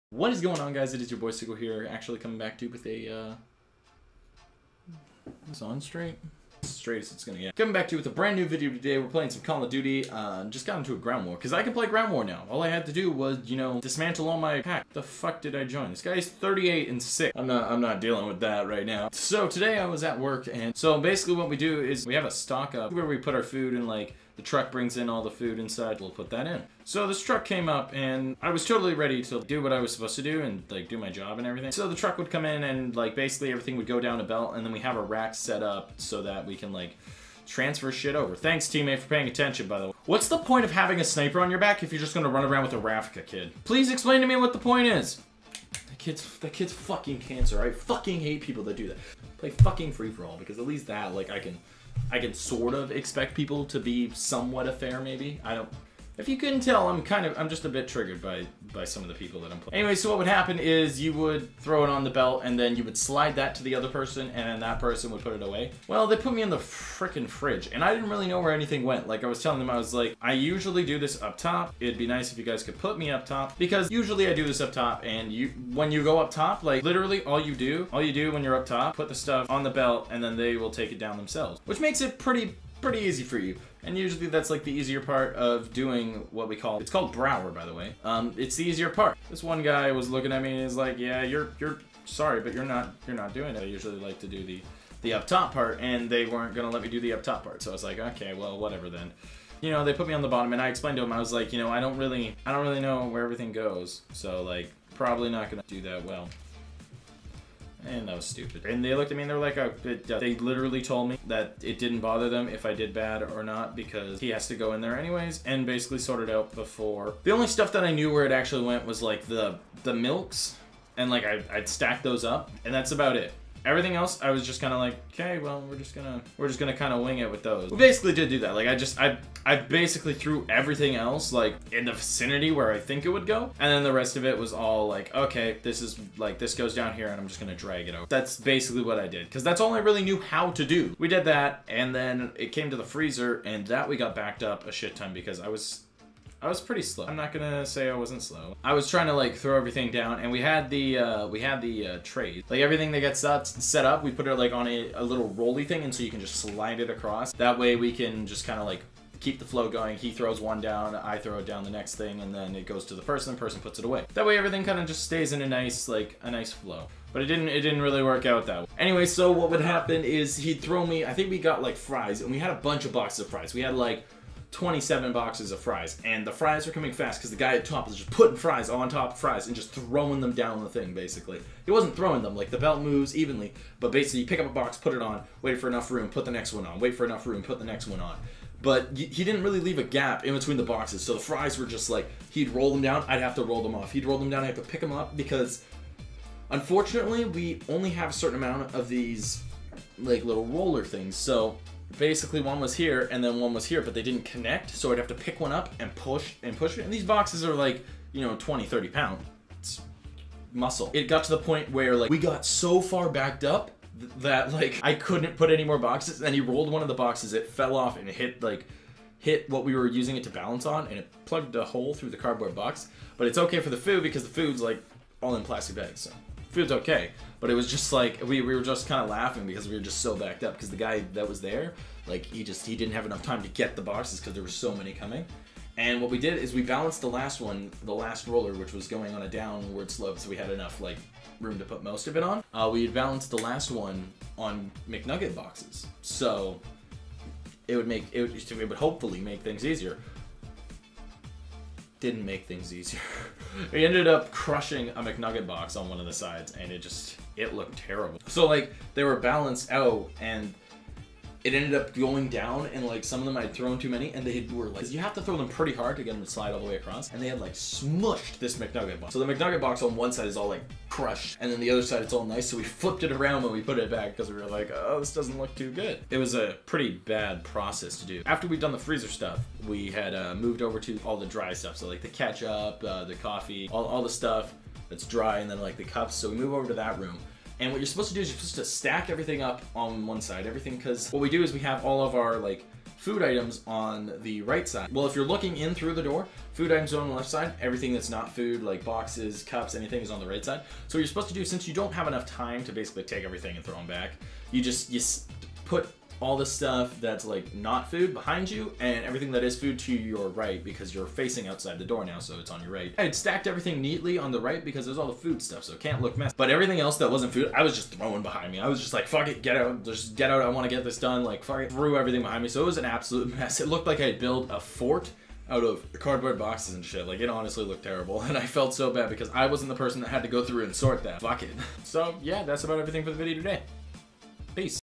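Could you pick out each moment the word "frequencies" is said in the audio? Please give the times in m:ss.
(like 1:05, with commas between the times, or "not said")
not said.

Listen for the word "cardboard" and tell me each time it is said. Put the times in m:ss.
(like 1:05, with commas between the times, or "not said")
3:42, 5:25.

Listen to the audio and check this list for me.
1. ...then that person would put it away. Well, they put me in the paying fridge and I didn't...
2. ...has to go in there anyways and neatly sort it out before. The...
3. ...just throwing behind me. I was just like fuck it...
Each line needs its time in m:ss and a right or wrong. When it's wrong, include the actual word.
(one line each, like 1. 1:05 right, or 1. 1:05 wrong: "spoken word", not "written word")
1. 1:04 wrong: "freaking", not "paying"
2. 1:54 wrong: "basically", not "neatly"
3. 5:17 right.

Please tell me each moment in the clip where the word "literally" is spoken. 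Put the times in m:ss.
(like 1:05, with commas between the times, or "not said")
1:16, 1:50.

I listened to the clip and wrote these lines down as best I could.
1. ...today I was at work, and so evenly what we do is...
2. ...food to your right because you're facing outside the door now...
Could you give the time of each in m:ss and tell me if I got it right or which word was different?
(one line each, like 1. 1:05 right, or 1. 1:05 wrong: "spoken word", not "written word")
1. 0:19 wrong: "basically", not "evenly"
2. 5:09 right.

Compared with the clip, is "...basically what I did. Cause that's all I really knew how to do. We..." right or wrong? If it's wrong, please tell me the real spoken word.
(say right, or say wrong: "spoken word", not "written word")
right.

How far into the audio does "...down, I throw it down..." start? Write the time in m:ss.
2:40.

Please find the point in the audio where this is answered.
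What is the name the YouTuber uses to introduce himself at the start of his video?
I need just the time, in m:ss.
0:01.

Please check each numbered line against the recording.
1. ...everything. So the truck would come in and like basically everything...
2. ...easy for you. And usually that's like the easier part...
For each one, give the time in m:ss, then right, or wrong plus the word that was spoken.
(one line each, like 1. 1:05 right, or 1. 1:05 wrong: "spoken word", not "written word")
1. 0:31 right
2. 1:22 right.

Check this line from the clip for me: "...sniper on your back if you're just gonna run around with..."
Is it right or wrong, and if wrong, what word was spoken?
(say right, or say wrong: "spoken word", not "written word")
right.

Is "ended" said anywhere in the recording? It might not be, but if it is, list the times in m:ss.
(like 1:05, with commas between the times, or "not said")
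4:13, 4:21.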